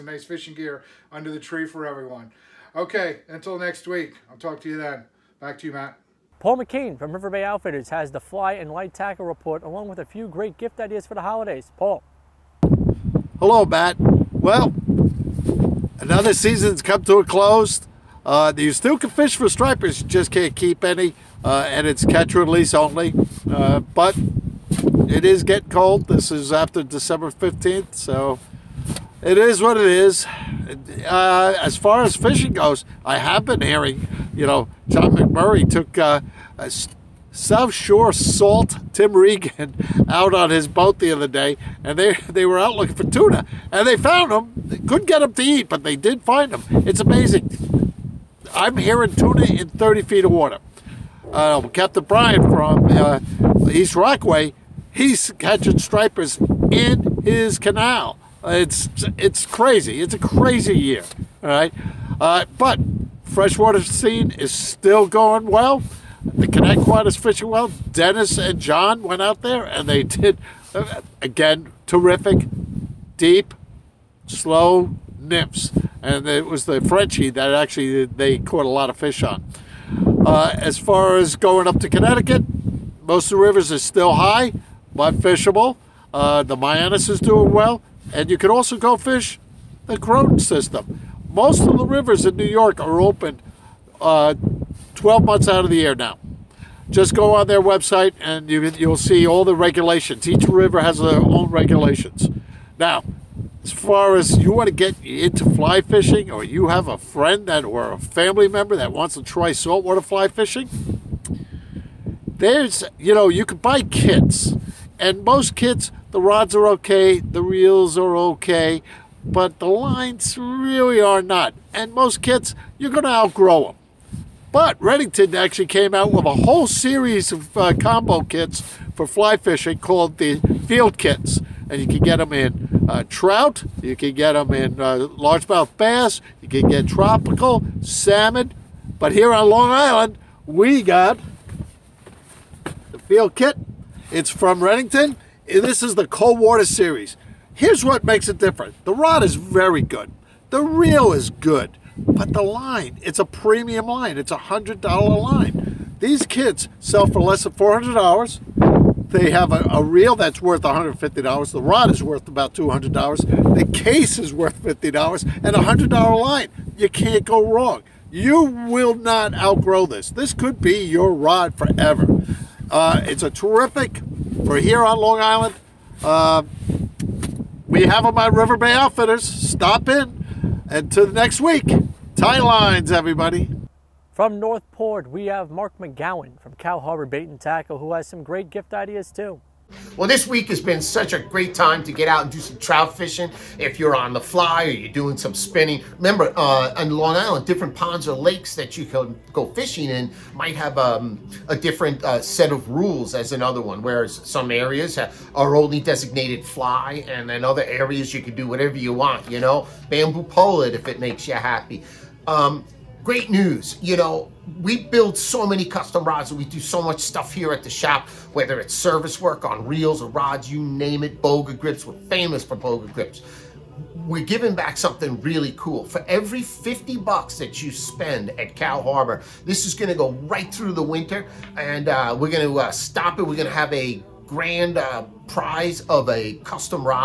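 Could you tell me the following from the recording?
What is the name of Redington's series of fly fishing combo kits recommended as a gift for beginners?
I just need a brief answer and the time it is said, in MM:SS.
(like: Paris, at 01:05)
field kits, at 02:10.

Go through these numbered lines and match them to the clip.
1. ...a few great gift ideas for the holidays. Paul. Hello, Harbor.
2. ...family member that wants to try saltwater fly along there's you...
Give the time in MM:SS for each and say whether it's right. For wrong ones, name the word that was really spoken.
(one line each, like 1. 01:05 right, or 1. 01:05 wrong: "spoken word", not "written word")
1. 00:09 wrong: "Matt", not "Harbor"
2. 01:47 wrong: "fishing", not "along".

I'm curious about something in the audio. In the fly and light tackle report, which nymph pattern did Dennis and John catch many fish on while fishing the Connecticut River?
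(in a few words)
Frenchie.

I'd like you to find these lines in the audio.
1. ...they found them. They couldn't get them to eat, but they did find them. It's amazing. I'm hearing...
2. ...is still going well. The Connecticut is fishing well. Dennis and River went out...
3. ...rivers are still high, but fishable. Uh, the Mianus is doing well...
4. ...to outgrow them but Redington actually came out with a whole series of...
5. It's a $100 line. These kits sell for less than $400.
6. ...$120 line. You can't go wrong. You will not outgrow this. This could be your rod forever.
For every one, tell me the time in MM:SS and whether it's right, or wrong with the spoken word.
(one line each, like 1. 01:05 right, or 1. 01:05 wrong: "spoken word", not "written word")
1. 00:43 right
2. 01:04 wrong: "John", not "River"
3. 01:23 right
4. 02:03 right
5. 02:34 right
6. 02:45 wrong: "100", not "120".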